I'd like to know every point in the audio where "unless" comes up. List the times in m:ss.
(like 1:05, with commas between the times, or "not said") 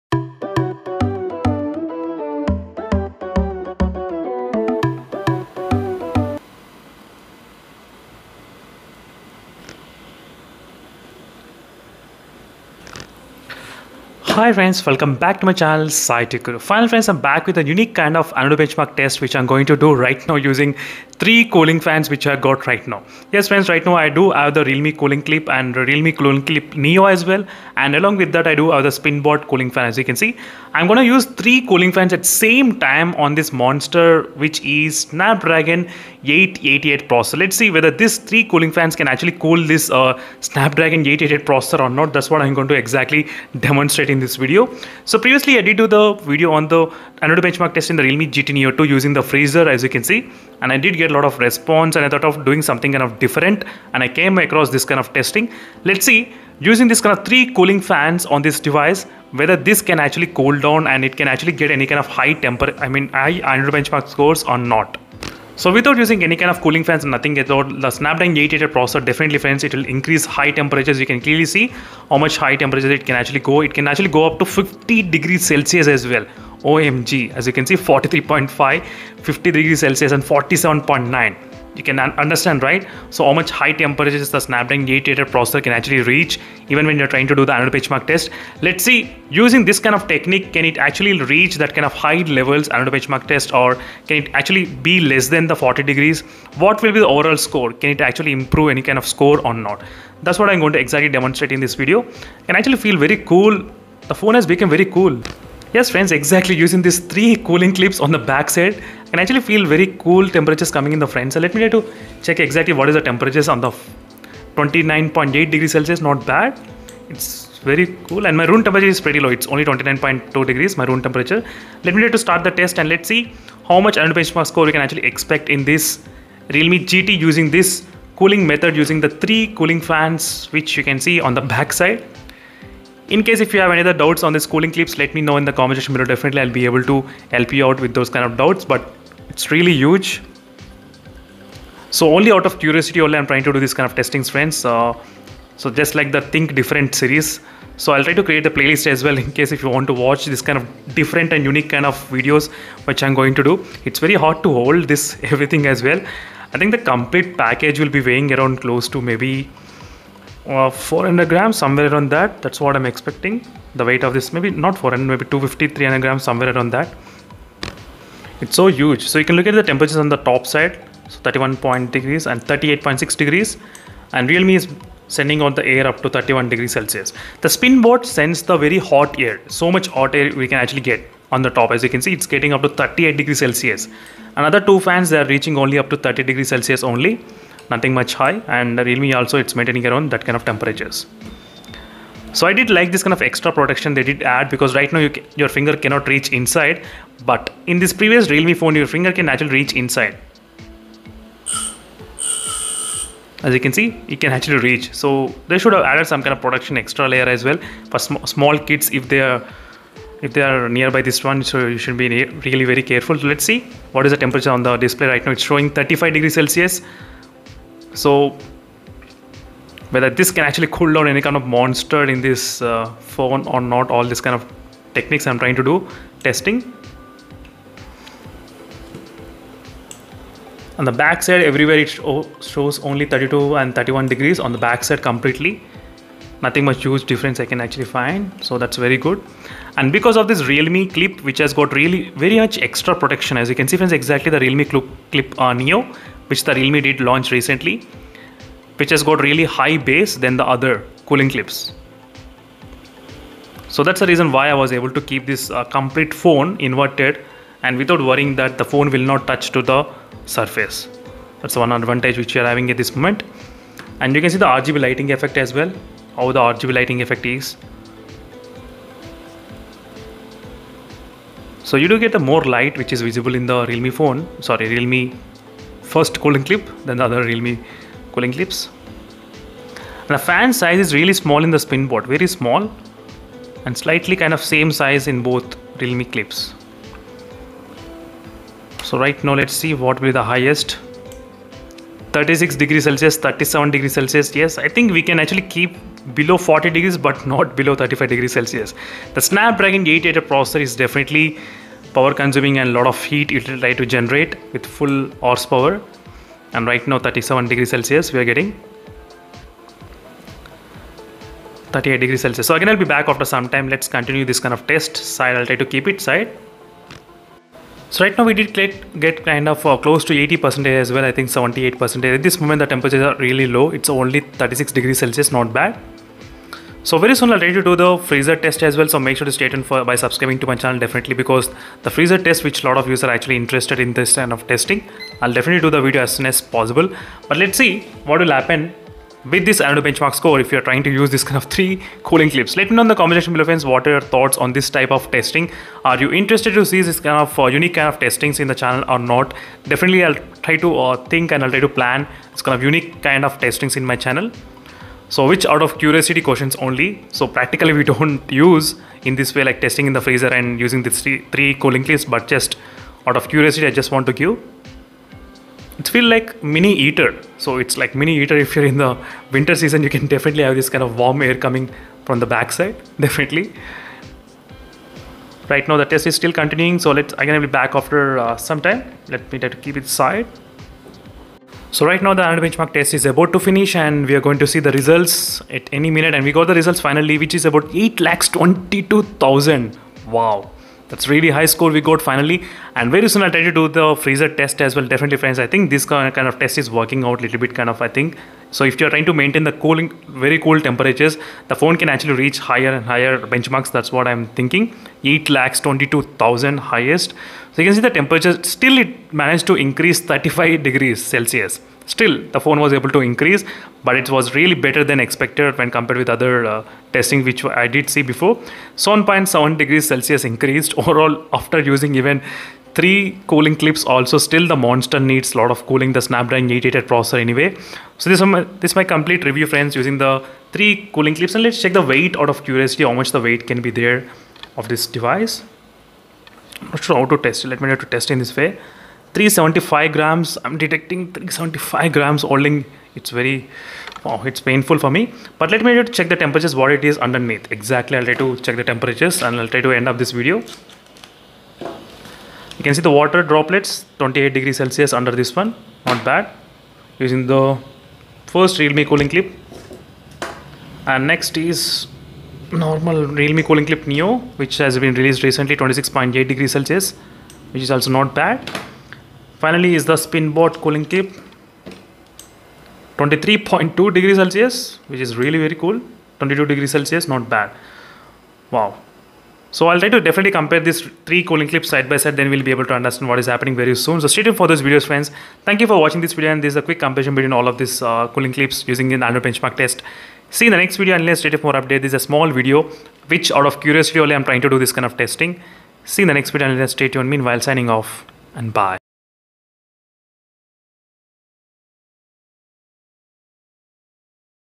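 8:10, 8:16.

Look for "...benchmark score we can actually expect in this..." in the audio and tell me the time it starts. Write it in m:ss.
2:04.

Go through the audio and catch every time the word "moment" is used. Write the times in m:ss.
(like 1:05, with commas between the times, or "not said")
4:22, 5:22.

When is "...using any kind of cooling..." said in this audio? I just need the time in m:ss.
1:05.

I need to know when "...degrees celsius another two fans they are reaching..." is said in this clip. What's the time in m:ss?
3:03.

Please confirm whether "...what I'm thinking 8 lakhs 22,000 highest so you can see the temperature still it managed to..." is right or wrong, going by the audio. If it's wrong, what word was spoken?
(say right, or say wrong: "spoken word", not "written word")
right.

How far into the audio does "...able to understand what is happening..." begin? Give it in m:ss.
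8:02.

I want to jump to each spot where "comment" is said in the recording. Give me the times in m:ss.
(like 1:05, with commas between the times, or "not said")
2:15, 5:42.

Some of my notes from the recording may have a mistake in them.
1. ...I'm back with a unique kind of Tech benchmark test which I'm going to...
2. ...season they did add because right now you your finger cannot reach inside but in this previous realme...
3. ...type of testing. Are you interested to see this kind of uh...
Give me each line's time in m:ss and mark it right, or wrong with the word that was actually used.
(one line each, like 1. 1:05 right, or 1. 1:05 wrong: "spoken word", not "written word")
1. 0:17 wrong: "Antutu", not "Tech"
2. 3:13 wrong: "protection", not "season"
3. 5:44 right.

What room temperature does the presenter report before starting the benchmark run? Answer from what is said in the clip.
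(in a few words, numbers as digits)
29.2 degrees.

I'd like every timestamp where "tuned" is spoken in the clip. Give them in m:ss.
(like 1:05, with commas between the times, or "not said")
5:29, 8:04, 8:16.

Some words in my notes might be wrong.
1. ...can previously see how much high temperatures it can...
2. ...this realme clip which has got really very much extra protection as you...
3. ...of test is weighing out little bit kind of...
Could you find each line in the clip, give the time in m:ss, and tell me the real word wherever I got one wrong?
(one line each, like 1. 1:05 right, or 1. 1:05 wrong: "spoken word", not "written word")
1. 1:11 wrong: "clearly", not "previously"
2. 4:00 right
3. 6:36 wrong: "working", not "weighing".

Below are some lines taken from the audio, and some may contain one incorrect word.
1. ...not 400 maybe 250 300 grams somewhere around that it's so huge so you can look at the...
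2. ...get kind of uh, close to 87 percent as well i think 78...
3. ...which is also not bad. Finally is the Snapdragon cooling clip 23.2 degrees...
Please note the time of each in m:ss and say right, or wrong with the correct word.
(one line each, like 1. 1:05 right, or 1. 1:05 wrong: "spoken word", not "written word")
1. 2:44 right
2. 5:18 wrong: "80", not "87"
3. 7:47 wrong: "SpinBot", not "Snapdragon".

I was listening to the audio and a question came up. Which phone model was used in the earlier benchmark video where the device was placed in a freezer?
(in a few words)
Realme GT Neo 2.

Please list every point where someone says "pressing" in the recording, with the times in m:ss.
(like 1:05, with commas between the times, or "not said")
not said.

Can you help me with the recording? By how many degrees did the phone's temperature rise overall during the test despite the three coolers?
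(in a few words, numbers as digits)
7.7 degrees Celsius.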